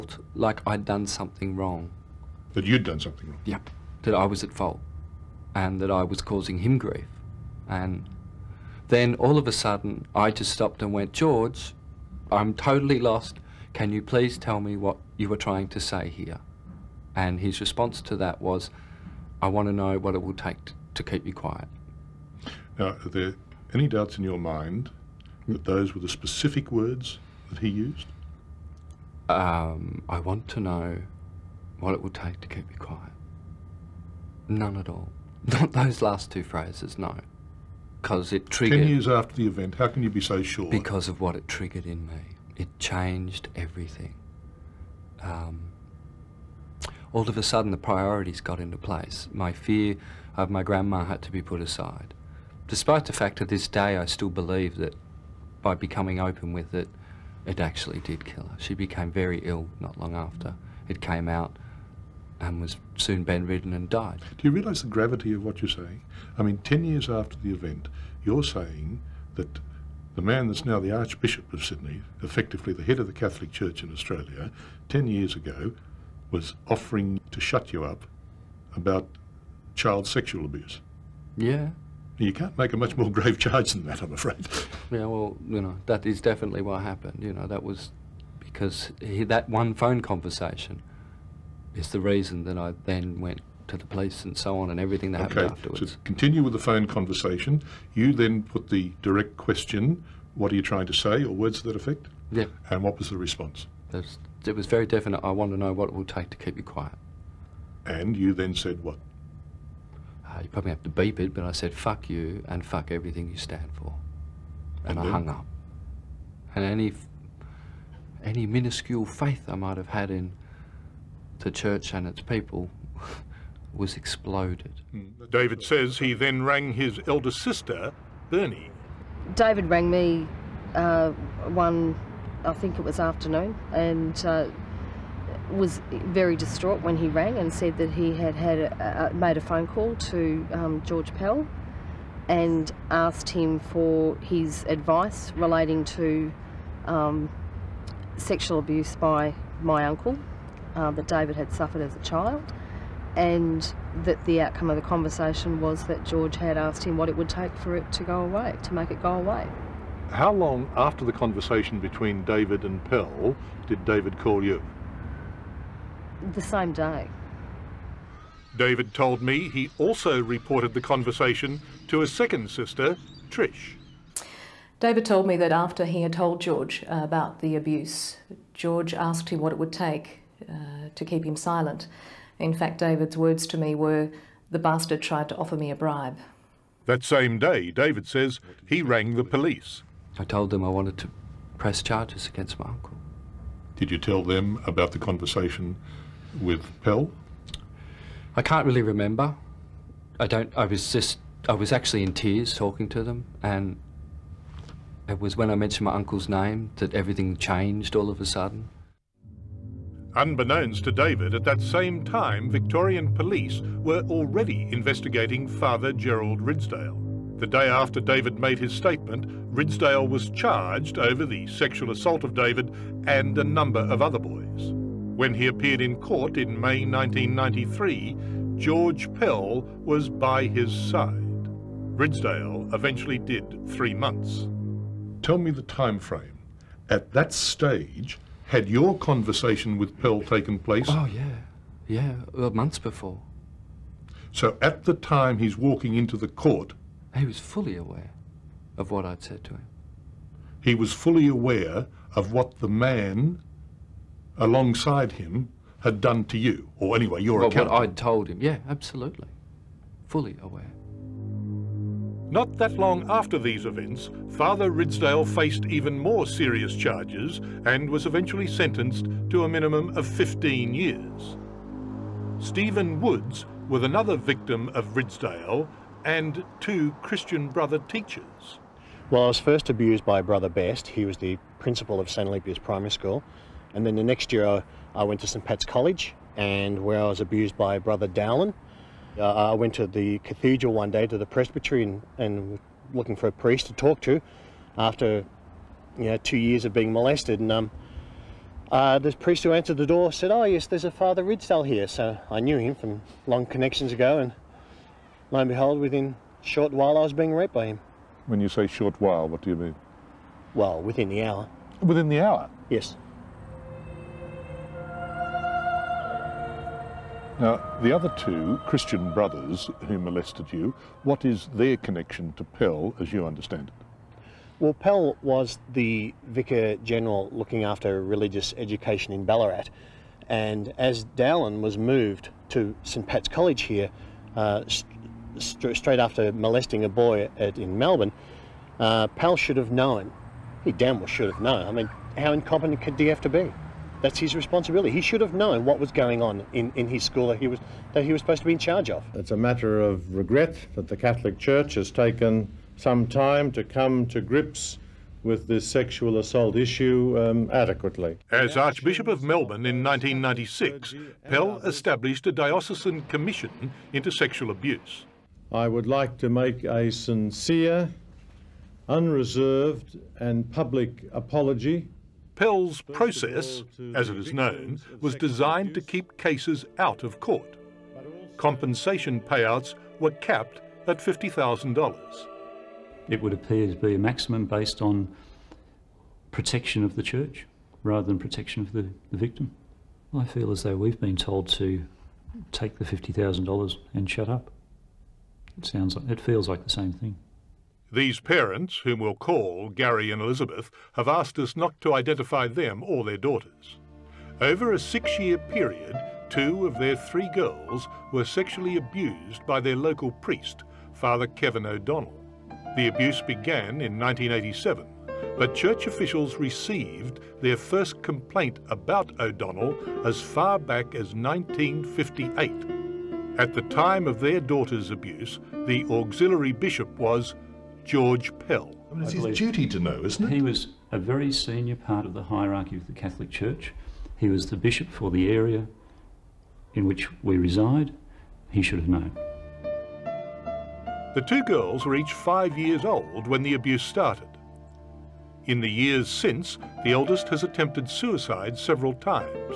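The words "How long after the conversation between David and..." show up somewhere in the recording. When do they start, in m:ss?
2:40.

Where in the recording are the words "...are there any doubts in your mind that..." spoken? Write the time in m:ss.
0:23.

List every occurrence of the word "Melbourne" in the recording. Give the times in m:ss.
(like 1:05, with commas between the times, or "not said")
5:37, 5:59.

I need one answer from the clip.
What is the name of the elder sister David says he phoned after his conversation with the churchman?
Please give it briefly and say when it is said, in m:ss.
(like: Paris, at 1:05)
Bernie, at 2:08.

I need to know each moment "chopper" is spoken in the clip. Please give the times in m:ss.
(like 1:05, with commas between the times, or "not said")
not said.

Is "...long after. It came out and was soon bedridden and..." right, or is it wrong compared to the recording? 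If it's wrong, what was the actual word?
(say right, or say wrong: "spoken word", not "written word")
right.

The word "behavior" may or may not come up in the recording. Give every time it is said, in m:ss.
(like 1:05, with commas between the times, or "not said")
not said.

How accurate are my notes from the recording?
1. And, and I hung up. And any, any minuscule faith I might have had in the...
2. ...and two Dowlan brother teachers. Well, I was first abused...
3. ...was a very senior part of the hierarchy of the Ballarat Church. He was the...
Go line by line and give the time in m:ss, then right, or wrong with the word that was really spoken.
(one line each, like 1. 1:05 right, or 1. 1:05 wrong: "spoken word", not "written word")
1. 1:54 right
2. 4:36 wrong: "Christian", not "Dowlan"
3. 7:10 wrong: "Catholic", not "Ballarat".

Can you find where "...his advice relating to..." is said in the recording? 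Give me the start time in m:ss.
2:24.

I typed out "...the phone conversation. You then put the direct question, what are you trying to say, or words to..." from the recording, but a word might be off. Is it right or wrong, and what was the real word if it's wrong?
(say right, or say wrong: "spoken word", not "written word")
right.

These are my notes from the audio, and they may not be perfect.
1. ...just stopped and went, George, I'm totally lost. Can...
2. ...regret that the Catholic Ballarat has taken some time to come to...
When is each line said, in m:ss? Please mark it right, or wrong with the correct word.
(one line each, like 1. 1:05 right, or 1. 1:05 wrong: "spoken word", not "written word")
1. 0:10 right
2. 5:50 wrong: "Church", not "Ballarat".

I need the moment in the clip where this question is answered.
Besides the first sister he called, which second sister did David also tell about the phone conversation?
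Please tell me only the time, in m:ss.
2:53.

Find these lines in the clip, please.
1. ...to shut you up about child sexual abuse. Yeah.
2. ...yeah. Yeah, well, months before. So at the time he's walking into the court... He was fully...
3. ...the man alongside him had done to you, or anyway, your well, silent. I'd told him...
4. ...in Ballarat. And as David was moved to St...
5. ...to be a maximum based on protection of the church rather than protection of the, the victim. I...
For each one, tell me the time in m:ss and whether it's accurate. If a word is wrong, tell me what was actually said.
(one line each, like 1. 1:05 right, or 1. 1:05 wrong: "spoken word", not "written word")
1. 1:17 right
2. 4:01 right
3. 4:12 wrong: "account", not "silent"
4. 5:29 wrong: "Dowlan", not "David"
5. 6:23 right.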